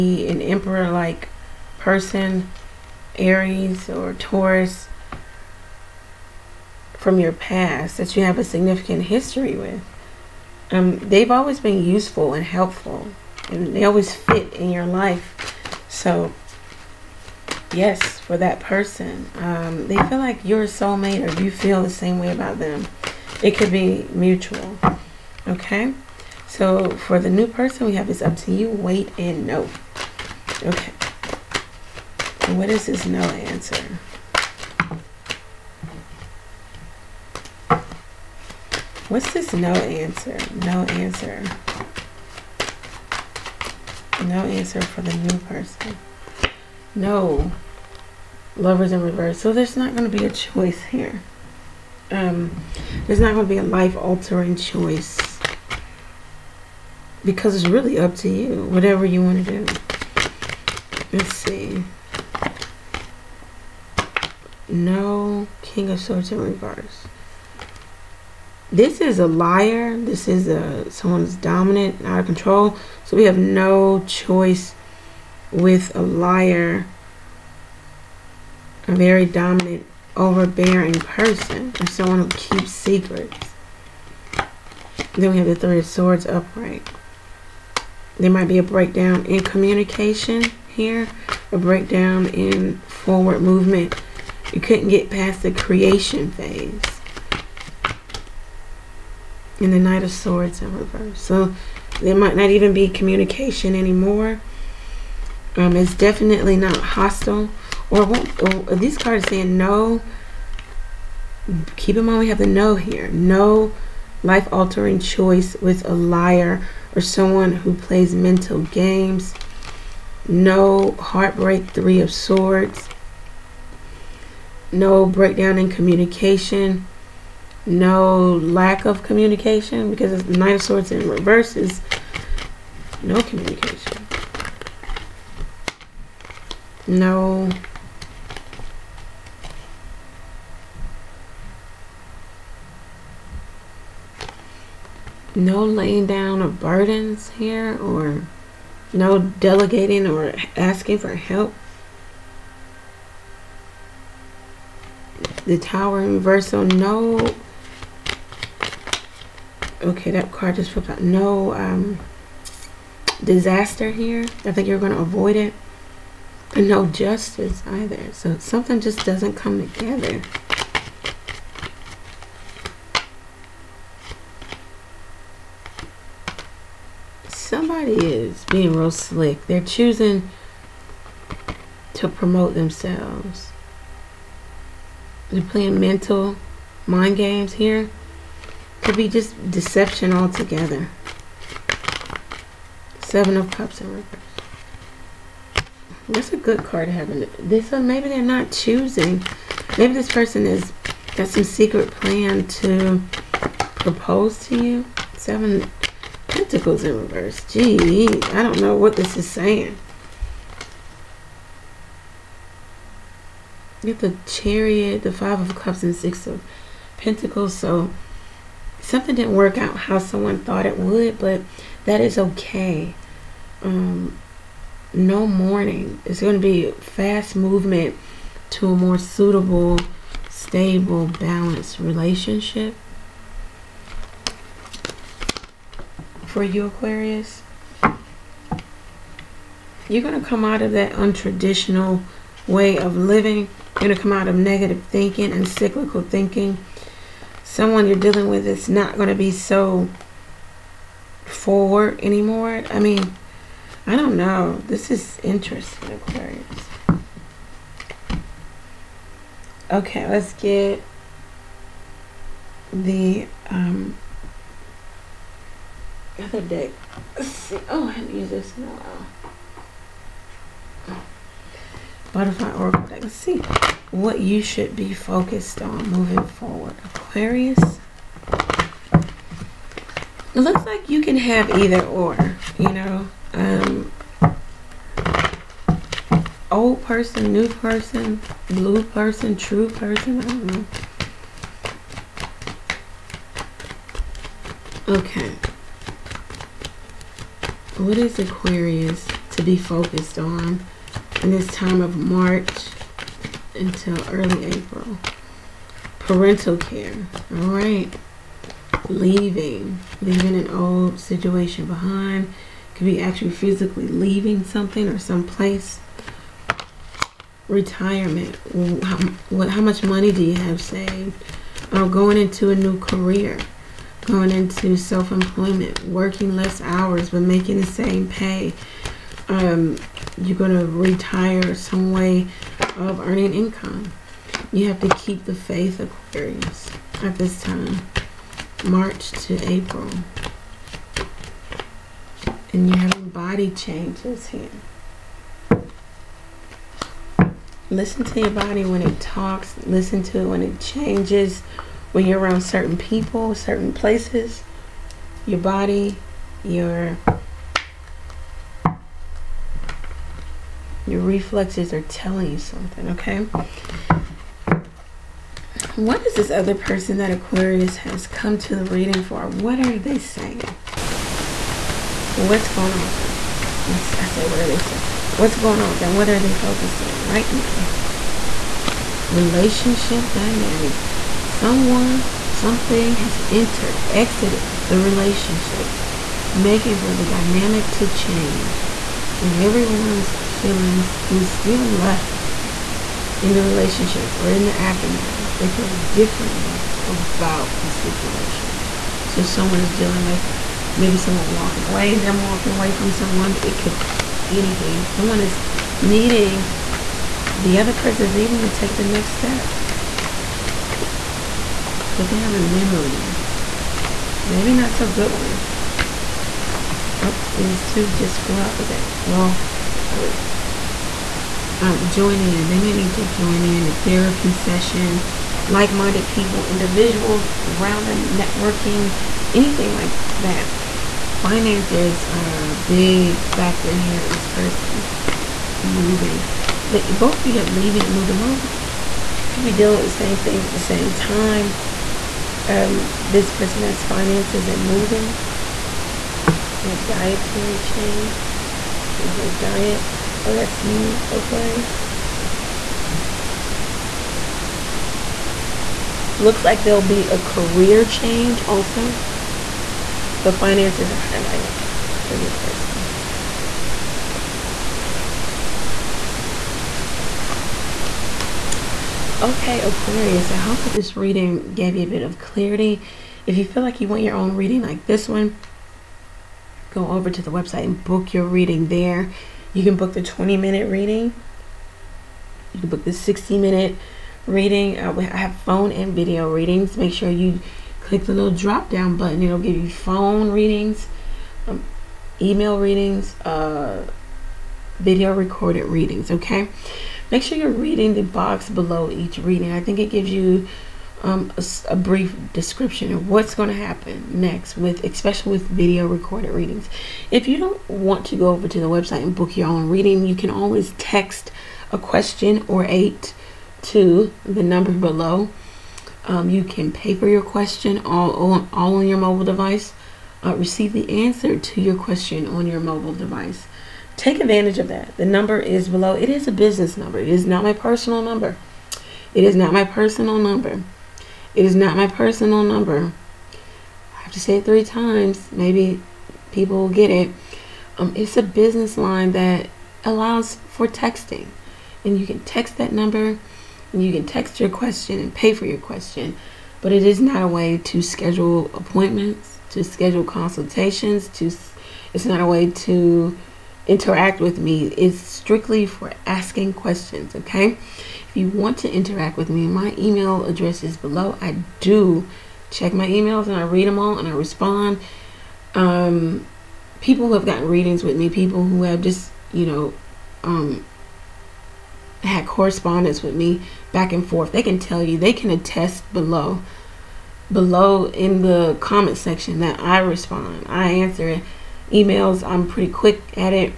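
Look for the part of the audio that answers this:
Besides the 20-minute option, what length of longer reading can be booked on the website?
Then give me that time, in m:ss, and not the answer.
8:02.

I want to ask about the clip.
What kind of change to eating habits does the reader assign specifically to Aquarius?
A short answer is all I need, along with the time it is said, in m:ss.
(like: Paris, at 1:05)
Dietary change, at 7:26.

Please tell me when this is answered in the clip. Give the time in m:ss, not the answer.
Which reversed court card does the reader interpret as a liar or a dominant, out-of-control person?
1:05.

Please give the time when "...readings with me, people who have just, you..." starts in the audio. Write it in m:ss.
9:27.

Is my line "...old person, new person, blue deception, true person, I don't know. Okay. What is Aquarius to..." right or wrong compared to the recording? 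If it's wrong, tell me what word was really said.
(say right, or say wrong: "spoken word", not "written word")
wrong: "person", not "deception".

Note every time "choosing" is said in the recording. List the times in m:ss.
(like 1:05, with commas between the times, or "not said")
2:59, 3:18.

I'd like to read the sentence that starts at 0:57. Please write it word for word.
Because it's really up to you.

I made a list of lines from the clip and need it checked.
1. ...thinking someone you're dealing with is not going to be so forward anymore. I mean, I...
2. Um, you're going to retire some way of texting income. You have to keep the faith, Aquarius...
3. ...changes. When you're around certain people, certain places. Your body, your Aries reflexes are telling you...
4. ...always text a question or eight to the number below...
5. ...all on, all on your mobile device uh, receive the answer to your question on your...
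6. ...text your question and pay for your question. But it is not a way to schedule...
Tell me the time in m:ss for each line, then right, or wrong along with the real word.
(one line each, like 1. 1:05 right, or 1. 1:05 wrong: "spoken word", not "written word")
1. 4:06 right
2. 5:29 wrong: "earning", not "texting"
3. 5:50 wrong: "Your", not "Aries"
4. 8:30 right
5. 8:37 right
6. 9:04 right.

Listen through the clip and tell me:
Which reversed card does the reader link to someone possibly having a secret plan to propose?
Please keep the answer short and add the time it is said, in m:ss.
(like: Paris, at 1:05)
Seven of Cups, at 3:13.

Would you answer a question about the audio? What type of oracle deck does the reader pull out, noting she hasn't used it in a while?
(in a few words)
Butterfly oracle deck.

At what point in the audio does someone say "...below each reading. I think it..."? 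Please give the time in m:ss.
8:18.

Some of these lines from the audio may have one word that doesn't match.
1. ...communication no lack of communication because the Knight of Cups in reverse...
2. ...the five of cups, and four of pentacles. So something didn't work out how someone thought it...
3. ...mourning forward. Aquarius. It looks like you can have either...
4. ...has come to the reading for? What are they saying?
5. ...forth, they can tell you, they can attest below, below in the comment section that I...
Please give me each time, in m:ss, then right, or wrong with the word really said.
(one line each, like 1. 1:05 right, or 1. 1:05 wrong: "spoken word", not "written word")
1. 2:05 wrong: "Swords", not "Cups"
2. 3:35 wrong: "six", not "four"
3. 4:35 wrong: "moving", not "mourning"
4. 6:07 right
5. 9:34 right.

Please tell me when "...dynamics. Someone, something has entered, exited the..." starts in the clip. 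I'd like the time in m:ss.
6:20.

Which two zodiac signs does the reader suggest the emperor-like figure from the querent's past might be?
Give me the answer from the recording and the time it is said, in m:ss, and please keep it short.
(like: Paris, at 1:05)
Aries or Taurus, at 0:03.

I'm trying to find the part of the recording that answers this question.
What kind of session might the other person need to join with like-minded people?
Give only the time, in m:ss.
7:03.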